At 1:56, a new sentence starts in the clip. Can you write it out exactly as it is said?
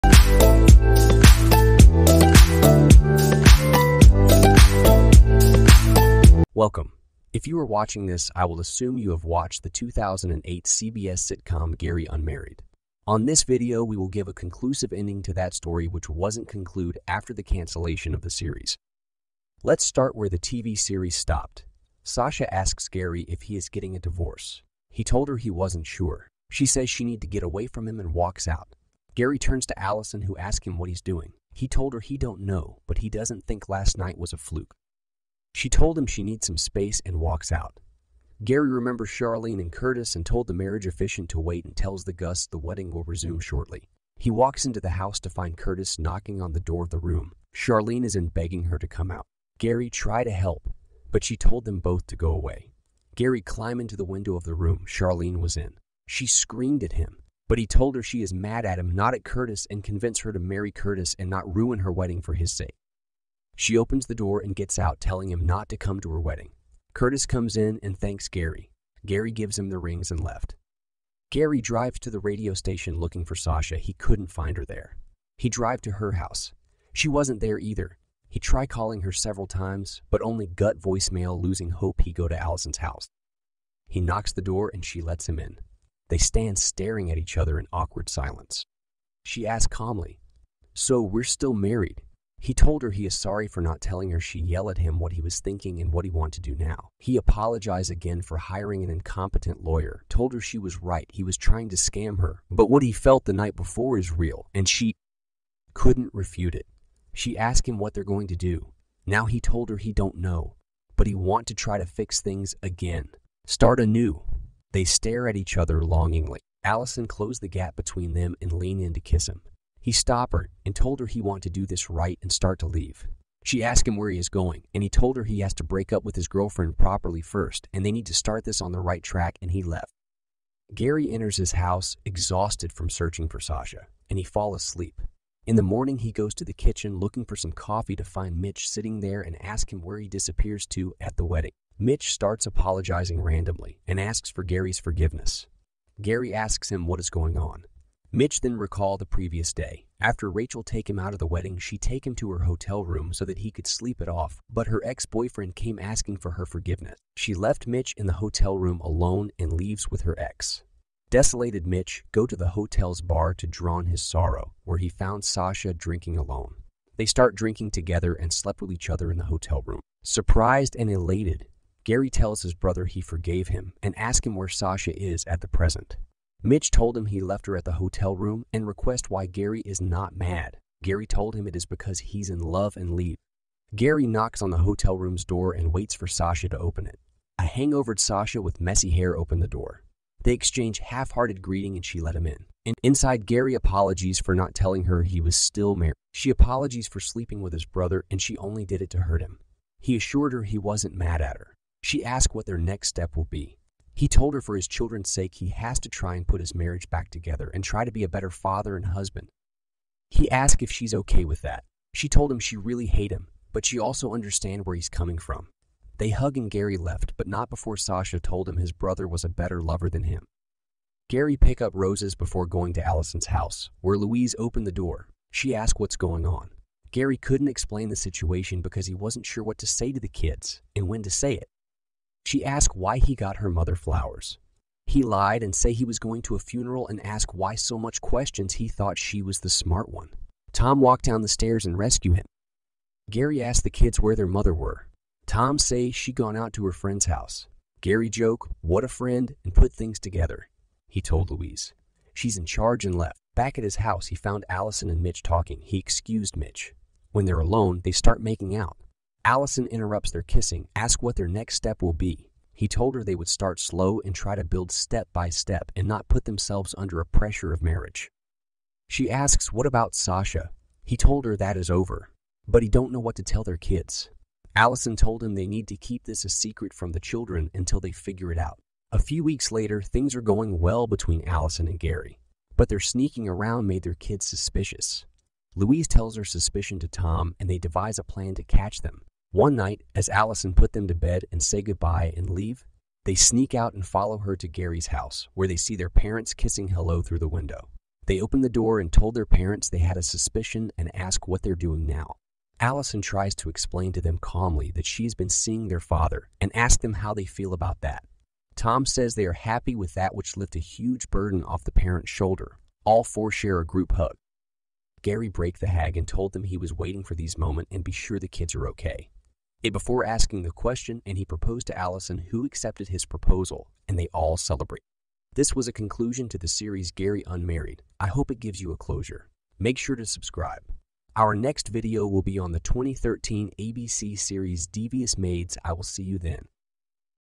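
Allison closed the gap between them and leaned in to kiss him.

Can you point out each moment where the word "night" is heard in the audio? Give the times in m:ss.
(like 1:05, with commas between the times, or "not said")
0:33, 1:43, 4:49.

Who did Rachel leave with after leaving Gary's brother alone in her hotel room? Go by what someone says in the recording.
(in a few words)
her ex-boyfriend.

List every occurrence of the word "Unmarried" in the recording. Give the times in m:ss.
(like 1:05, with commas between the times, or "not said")
0:12, 5:27.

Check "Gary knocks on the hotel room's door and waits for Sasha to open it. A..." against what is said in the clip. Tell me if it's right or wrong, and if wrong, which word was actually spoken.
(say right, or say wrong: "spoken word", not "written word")
right.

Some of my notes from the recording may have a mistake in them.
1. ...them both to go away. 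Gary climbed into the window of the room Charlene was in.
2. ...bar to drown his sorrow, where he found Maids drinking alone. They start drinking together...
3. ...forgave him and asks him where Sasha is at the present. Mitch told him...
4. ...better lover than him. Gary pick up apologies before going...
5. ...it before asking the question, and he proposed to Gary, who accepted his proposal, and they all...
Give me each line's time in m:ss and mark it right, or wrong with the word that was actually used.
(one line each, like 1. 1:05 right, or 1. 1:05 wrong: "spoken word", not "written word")
1. 0:51 right
2. 2:42 wrong: "Sasha", not "Maids"
3. 2:52 right
4. 3:39 wrong: "roses", not "apologies"
5. 5:19 wrong: "Allison", not "Gary".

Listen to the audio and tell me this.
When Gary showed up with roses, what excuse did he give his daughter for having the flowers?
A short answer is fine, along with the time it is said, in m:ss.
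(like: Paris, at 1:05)
a funeral, at 3:56.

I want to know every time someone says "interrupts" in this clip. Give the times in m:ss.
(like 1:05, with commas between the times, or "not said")
4:19.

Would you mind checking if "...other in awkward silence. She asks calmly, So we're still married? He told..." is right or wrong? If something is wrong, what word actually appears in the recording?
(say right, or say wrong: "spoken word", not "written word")
right.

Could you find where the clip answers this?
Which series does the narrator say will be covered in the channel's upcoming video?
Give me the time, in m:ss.
5:34.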